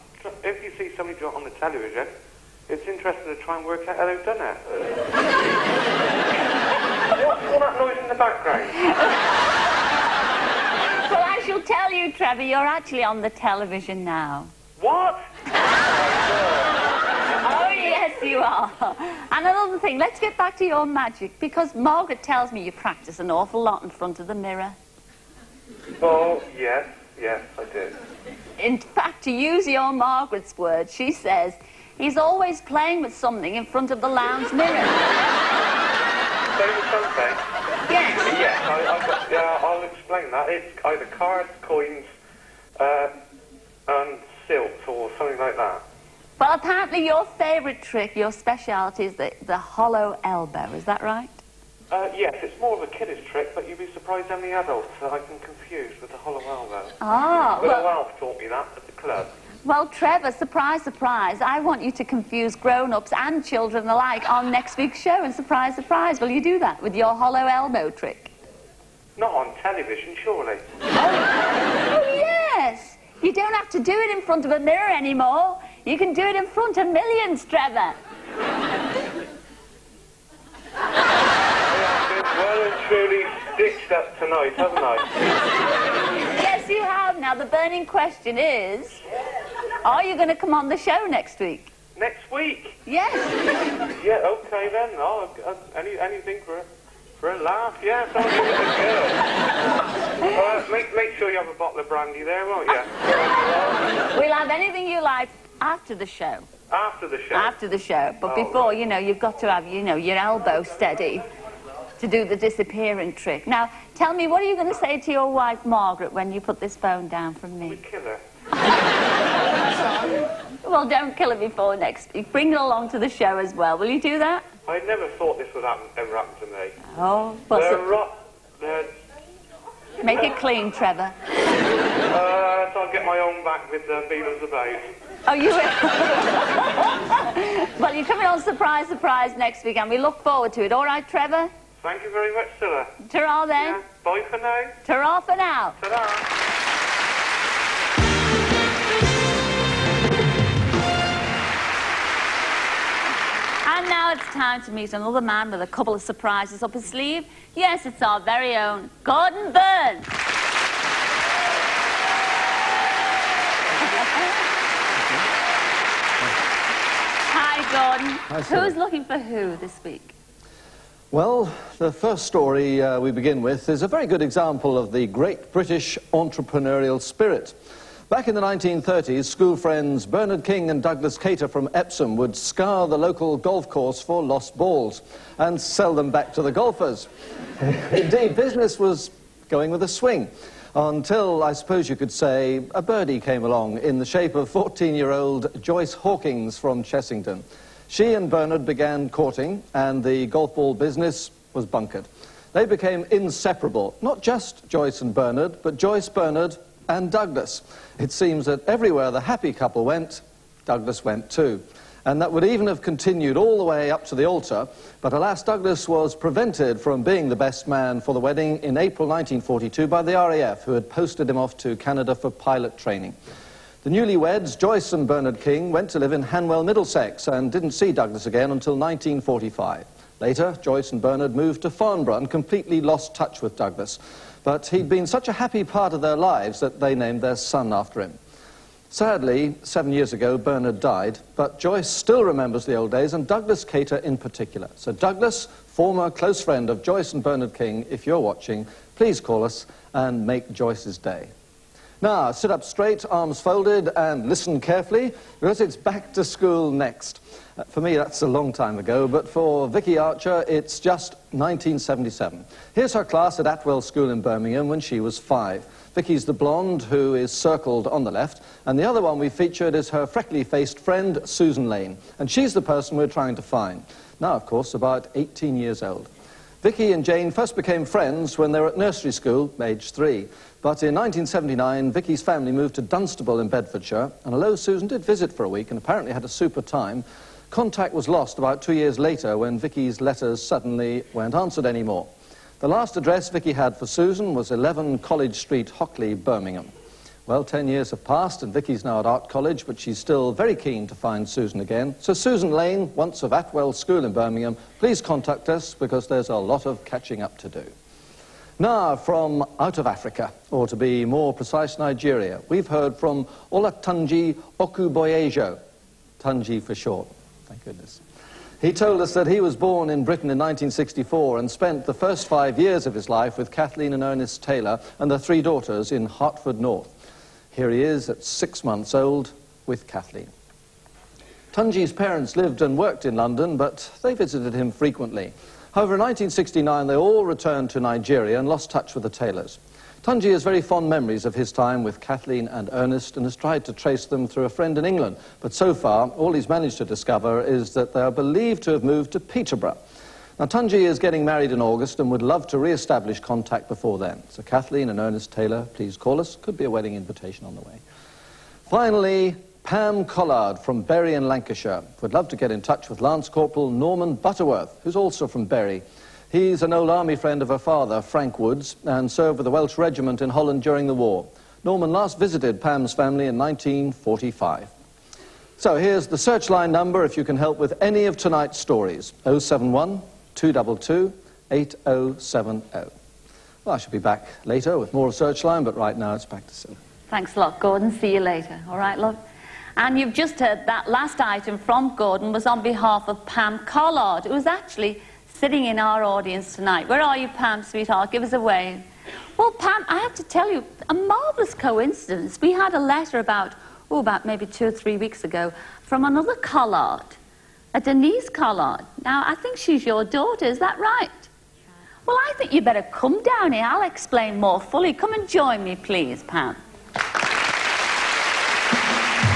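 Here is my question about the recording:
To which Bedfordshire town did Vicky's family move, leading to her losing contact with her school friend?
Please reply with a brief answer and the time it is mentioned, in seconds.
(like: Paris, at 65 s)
Dunstable, at 282 s.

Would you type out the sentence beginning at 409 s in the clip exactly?
Now, I think she's your daughter, is that right?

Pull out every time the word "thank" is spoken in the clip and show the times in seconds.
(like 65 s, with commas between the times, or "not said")
141 s, 317 s, 387 s.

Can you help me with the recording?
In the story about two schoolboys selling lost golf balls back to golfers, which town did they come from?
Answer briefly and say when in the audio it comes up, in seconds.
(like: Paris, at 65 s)
Epsom, at 181 s.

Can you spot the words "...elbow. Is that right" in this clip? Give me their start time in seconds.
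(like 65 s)
50 s.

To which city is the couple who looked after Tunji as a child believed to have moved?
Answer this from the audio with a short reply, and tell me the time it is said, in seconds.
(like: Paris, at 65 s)
Peterborough, at 349 s.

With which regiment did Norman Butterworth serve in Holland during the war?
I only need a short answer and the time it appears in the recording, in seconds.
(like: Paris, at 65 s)
the Welsh Regiment, at 369 s.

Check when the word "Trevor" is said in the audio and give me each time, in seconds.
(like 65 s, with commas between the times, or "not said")
12 s, 59 s, 77 s, 130 s, 141 s.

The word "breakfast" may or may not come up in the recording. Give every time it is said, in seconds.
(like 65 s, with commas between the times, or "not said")
not said.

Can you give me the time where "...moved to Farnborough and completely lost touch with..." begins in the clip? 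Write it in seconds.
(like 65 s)
231 s.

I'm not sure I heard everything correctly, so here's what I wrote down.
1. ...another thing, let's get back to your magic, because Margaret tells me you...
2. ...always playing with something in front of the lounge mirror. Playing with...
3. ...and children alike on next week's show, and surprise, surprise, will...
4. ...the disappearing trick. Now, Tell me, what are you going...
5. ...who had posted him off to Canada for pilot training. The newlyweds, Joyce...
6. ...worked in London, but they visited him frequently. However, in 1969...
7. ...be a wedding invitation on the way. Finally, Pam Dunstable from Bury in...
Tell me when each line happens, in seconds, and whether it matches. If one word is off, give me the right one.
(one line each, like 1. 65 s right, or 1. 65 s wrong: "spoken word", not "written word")
1. 19 s right
2. 32 s right
3. 63 s right
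4. 112 s right
5. 220 s right
6. 332 s right
7. 356 s wrong: "Collard", not "Dunstable".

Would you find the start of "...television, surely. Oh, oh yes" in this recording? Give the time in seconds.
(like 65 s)
69 s.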